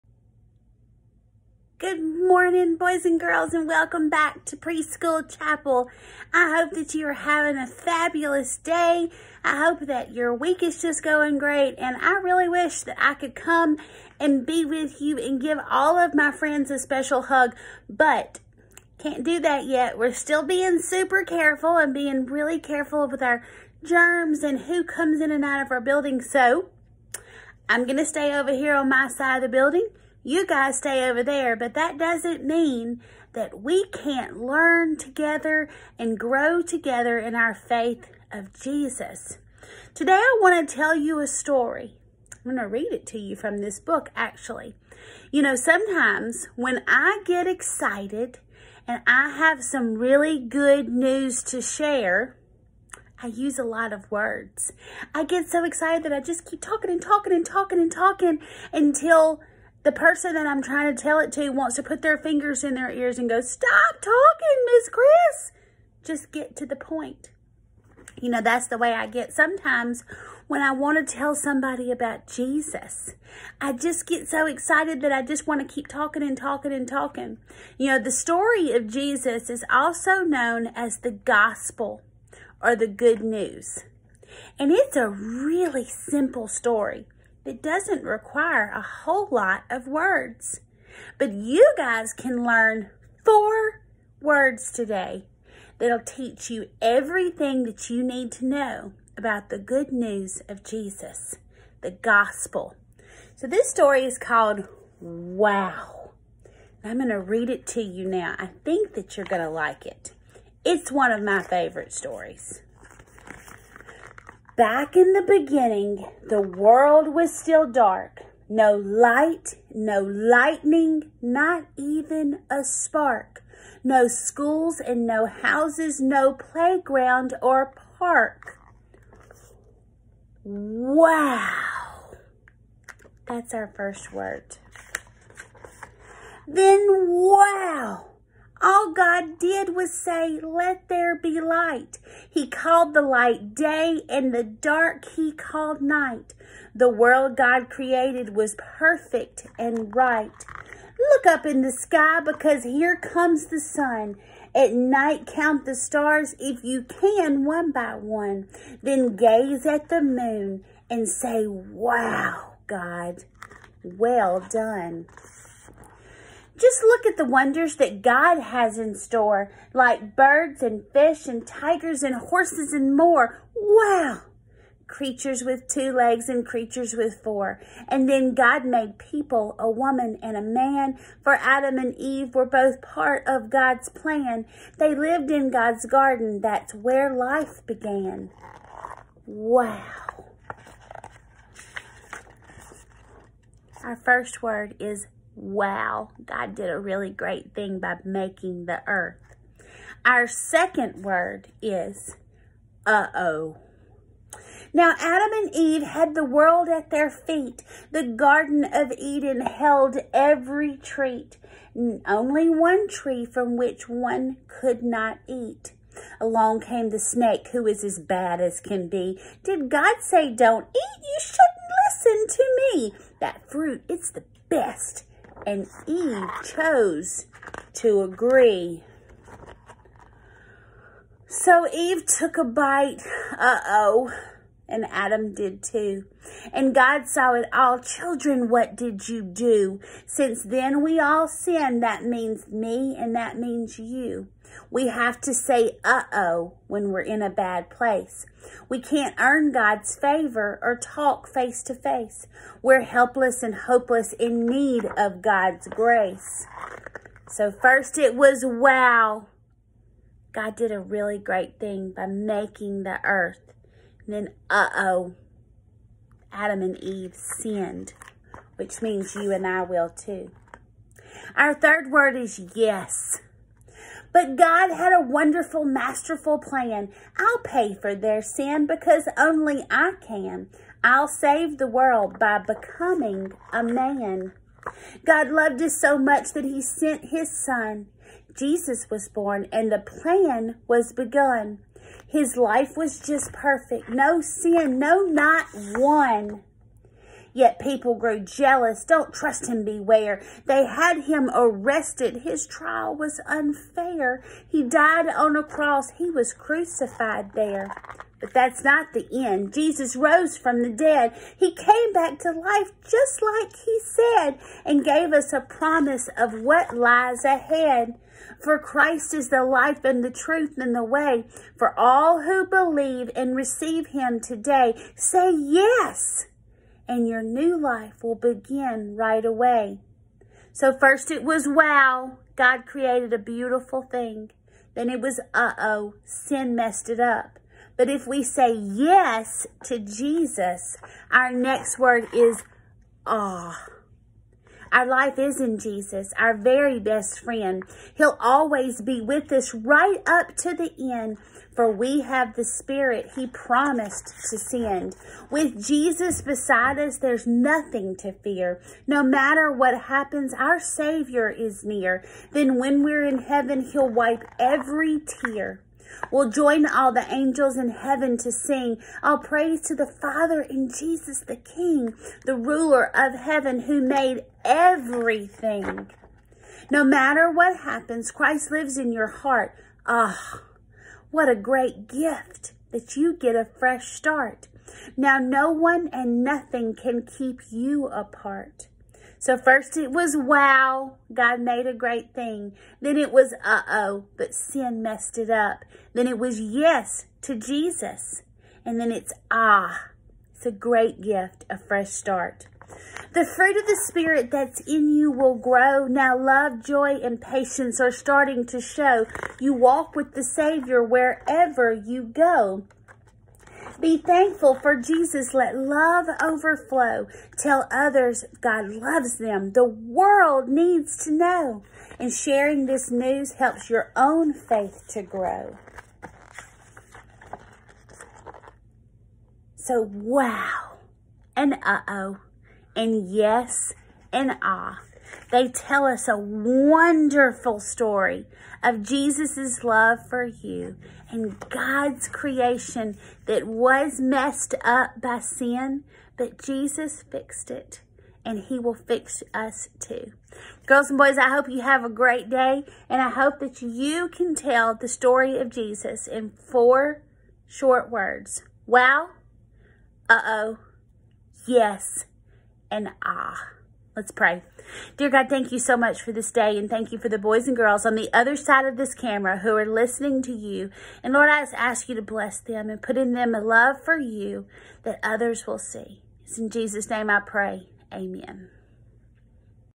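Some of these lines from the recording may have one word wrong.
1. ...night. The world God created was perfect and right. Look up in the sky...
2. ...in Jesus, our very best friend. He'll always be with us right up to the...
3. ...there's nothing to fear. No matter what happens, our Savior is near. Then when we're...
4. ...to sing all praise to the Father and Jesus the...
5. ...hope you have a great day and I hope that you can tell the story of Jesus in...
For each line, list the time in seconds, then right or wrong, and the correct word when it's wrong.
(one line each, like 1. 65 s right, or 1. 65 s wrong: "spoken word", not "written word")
1. 145 s right
2. 345 s right
3. 356 s right
4. 368 s right
5. 451 s right.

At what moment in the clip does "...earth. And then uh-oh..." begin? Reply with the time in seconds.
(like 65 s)
263 s.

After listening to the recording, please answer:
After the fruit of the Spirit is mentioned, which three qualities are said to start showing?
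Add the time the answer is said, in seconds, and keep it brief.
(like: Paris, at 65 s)
love, joy, and patience, at 406 s.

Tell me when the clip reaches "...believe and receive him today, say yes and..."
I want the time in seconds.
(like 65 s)
322 s.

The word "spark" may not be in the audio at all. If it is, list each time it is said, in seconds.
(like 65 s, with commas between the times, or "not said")
122 s.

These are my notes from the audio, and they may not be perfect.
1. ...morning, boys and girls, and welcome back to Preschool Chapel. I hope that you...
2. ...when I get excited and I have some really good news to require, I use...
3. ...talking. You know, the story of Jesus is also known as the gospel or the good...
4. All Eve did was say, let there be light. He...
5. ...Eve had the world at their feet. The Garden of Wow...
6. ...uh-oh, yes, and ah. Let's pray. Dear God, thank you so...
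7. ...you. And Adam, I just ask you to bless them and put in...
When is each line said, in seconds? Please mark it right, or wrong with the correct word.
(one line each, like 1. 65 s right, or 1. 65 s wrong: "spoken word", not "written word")
1. 1 s right
2. 46 s wrong: "share", not "require"
3. 76 s right
4. 138 s wrong: "God", not "Eve"
5. 205 s wrong: "Eden", not "Wow"
6. 460 s right
7. 470 s wrong: "Lord", not "Adam".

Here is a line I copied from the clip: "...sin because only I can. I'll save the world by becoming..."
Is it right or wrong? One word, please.
right.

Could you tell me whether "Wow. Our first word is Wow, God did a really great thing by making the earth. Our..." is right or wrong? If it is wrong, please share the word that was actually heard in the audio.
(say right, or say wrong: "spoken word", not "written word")
right.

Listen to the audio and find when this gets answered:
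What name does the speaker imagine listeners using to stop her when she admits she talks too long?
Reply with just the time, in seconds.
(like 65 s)
64 s.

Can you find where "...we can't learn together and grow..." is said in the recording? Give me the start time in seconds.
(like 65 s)
33 s.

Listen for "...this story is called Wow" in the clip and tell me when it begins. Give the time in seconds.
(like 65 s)
103 s.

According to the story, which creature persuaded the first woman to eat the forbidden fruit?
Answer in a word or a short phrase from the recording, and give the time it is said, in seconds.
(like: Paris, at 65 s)
the snake, at 216 s.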